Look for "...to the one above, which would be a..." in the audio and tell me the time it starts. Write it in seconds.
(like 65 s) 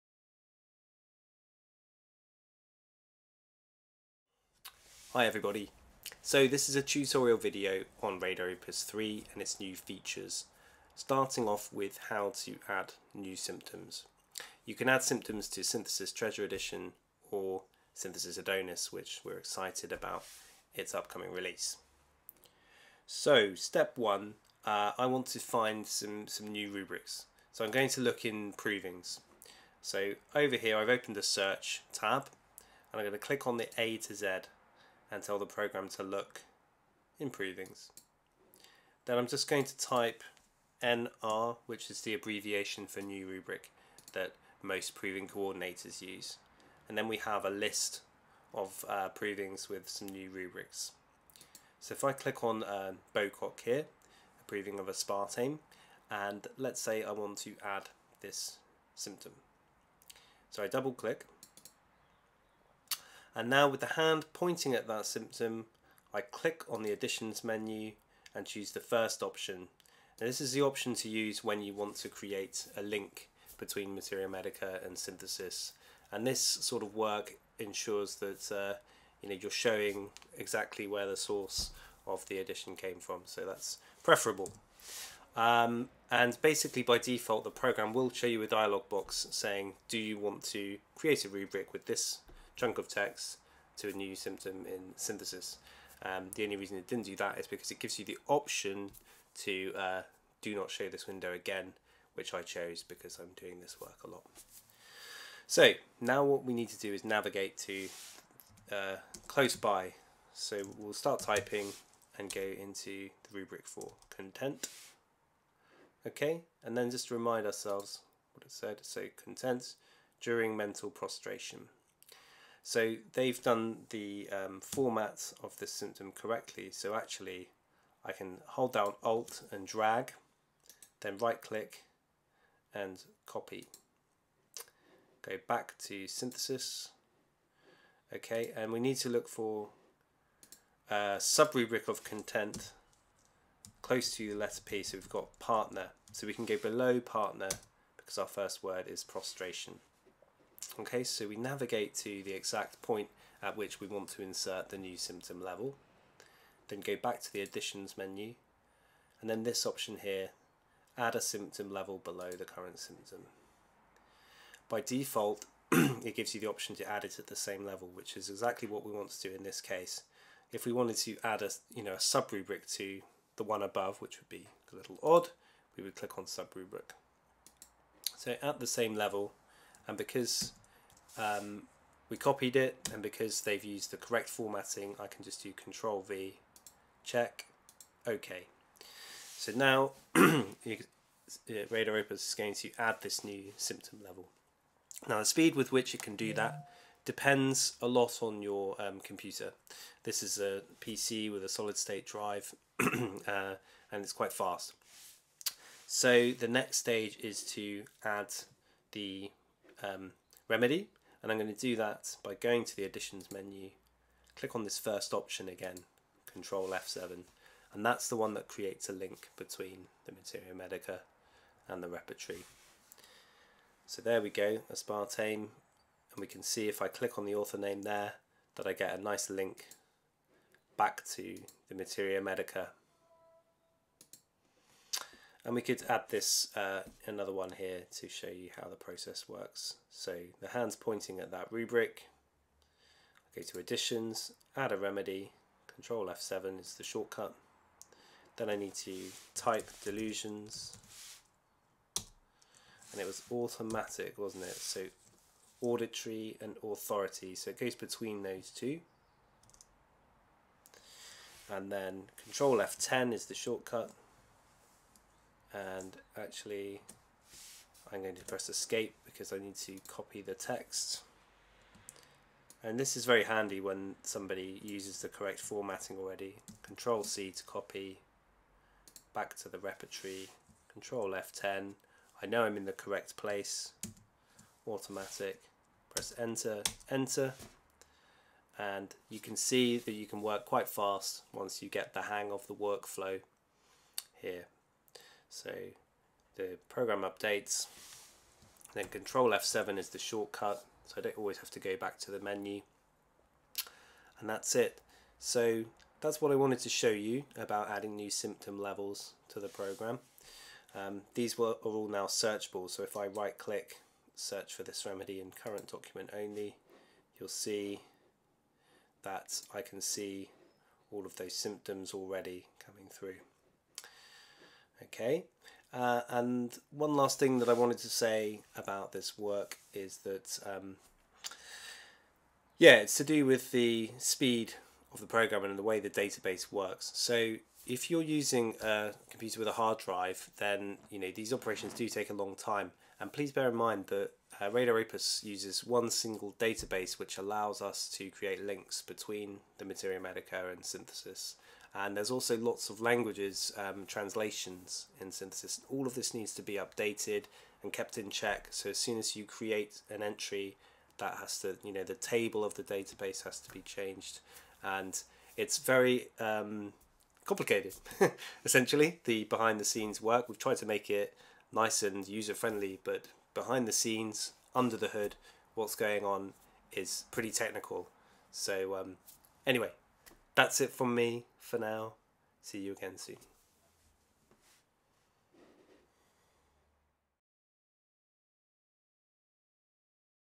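172 s.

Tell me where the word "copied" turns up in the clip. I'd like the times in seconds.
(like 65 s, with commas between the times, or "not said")
182 s.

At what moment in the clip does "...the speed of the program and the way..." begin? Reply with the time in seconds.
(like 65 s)
333 s.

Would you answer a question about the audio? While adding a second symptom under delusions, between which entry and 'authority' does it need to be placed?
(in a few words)
Auditory.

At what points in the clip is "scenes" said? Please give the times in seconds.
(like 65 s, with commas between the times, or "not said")
369 s, 373 s.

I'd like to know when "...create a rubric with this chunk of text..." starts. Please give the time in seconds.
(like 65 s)
90 s.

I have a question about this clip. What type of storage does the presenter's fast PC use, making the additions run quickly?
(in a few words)
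Solid state drive.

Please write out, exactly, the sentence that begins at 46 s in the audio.
And then we have a list of uh, provings with some new rubrics.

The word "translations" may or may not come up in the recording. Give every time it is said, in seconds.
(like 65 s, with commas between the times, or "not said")
353 s.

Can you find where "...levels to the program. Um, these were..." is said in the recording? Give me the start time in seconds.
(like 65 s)
308 s.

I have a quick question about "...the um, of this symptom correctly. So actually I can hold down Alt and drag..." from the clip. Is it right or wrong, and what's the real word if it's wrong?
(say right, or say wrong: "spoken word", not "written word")
right.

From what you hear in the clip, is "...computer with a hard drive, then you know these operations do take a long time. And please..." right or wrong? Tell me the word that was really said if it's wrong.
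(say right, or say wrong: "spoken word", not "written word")
right.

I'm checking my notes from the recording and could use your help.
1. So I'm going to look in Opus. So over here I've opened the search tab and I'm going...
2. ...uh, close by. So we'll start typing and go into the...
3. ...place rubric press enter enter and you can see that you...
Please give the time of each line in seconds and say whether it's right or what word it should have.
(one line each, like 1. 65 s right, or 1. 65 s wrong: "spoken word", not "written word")
1. 27 s wrong: "Provings", not "Opus"
2. 108 s right
3. 283 s wrong: "automatic", not "rubric".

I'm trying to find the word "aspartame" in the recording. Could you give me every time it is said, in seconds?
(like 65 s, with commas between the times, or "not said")
54 s, 224 s.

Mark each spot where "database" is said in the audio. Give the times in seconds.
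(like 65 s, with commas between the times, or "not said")
335 s, 346 s, 362 s.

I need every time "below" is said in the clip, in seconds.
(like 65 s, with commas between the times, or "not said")
146 s, 161 s.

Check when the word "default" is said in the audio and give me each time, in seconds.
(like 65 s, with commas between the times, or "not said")
86 s, 164 s.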